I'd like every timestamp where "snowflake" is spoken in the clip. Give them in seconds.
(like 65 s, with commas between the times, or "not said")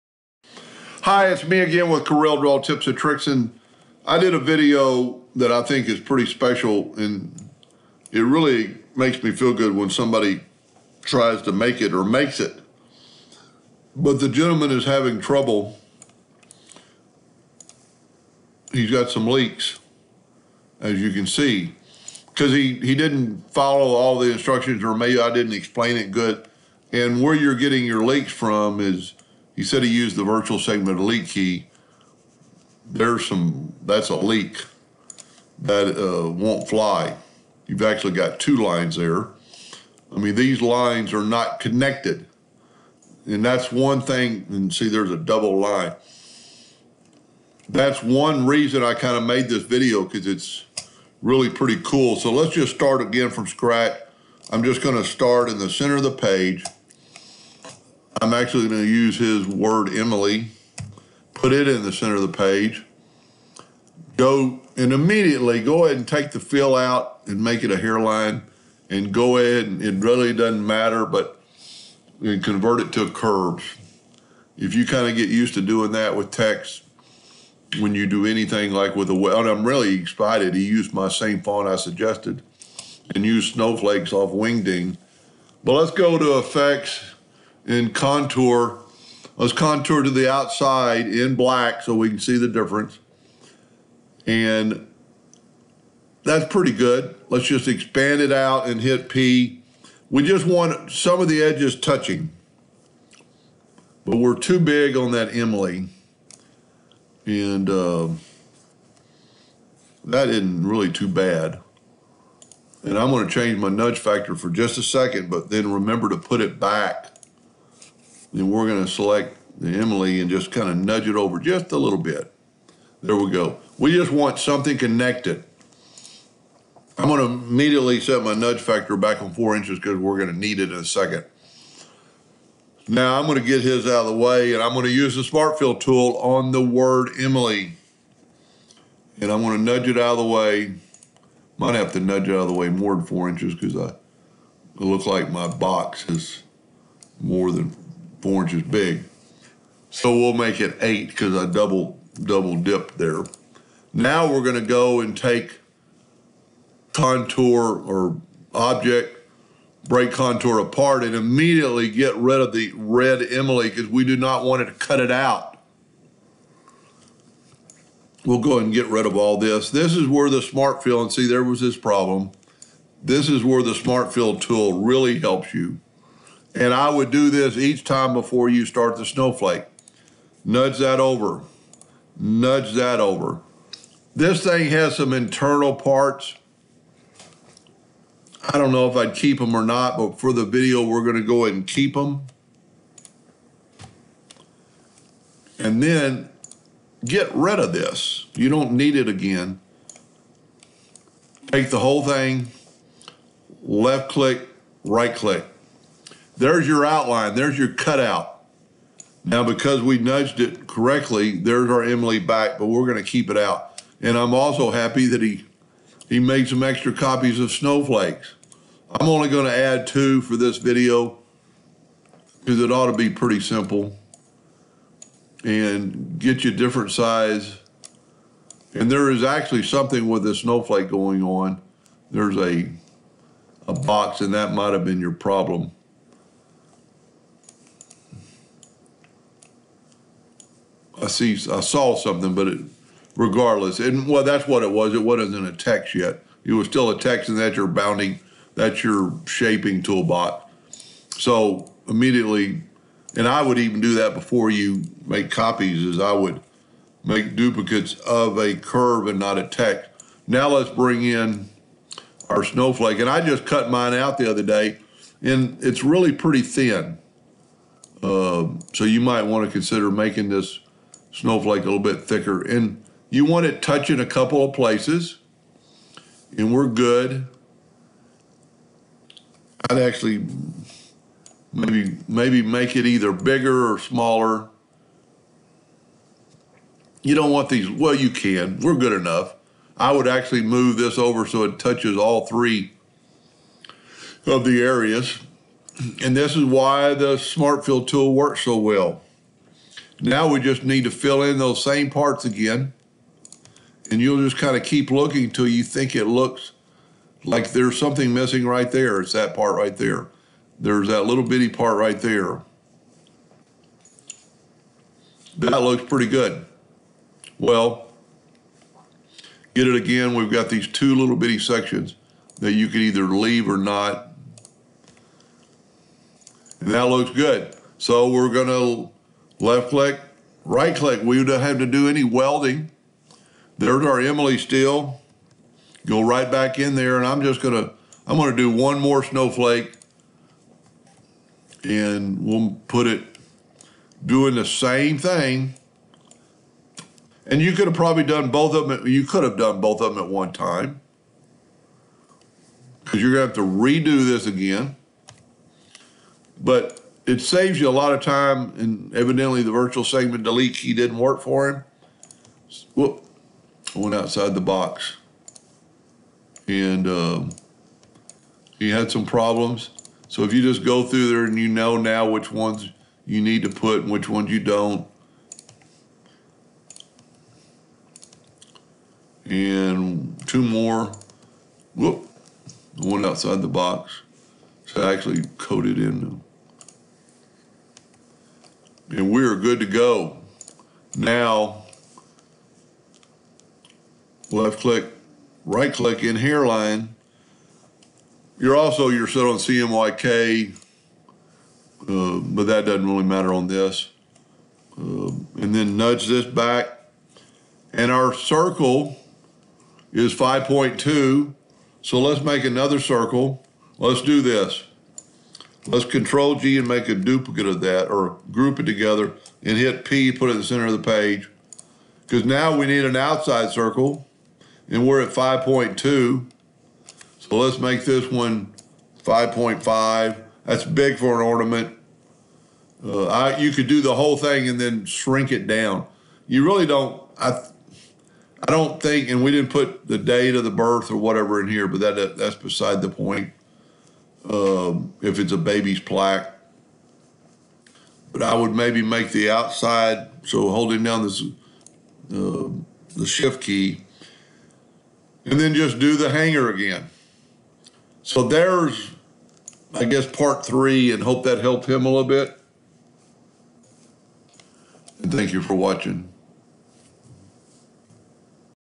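83 s, 179 s, 217 s, 230 s, 262 s, 271 s, 339 s.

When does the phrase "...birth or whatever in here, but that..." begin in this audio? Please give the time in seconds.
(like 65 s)
440 s.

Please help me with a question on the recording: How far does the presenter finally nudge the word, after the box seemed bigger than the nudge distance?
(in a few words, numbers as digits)
8.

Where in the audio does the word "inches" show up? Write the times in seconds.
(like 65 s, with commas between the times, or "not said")
129 s, 143 s, 148 s.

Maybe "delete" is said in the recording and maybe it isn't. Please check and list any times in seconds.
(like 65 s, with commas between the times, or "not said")
30 s, 360 s.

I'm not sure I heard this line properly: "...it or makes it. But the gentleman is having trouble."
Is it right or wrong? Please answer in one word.
right.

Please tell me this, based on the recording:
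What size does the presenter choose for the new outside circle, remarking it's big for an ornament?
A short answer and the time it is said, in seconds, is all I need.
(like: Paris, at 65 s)
5.5, at 429 s.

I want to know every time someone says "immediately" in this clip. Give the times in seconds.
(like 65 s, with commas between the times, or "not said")
64 s, 127 s, 161 s, 251 s.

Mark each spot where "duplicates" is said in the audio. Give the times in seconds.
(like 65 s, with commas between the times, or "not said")
257 s, 416 s.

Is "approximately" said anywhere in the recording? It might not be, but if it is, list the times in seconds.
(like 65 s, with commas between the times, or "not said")
not said.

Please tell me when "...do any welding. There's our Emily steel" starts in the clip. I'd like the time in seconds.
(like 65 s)
331 s.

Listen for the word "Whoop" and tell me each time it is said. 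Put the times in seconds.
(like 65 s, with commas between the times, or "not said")
362 s, 381 s.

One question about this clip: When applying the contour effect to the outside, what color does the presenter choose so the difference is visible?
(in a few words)
black.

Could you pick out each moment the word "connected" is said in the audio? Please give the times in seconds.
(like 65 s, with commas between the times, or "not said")
41 s, 124 s.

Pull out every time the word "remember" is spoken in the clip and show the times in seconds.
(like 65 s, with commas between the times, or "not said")
115 s.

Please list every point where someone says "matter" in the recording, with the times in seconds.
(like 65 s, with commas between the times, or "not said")
70 s, 403 s.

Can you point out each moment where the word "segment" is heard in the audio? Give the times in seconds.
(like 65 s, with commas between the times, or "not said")
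30 s, 359 s.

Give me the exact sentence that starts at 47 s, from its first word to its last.
That's one reason I kind of made this video because it's really pretty cool.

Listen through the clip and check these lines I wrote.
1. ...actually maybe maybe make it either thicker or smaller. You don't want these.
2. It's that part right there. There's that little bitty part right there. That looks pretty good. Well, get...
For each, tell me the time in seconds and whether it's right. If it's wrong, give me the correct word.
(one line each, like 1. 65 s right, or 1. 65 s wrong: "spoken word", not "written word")
1. 279 s wrong: "bigger", not "thicker"
2. 309 s right.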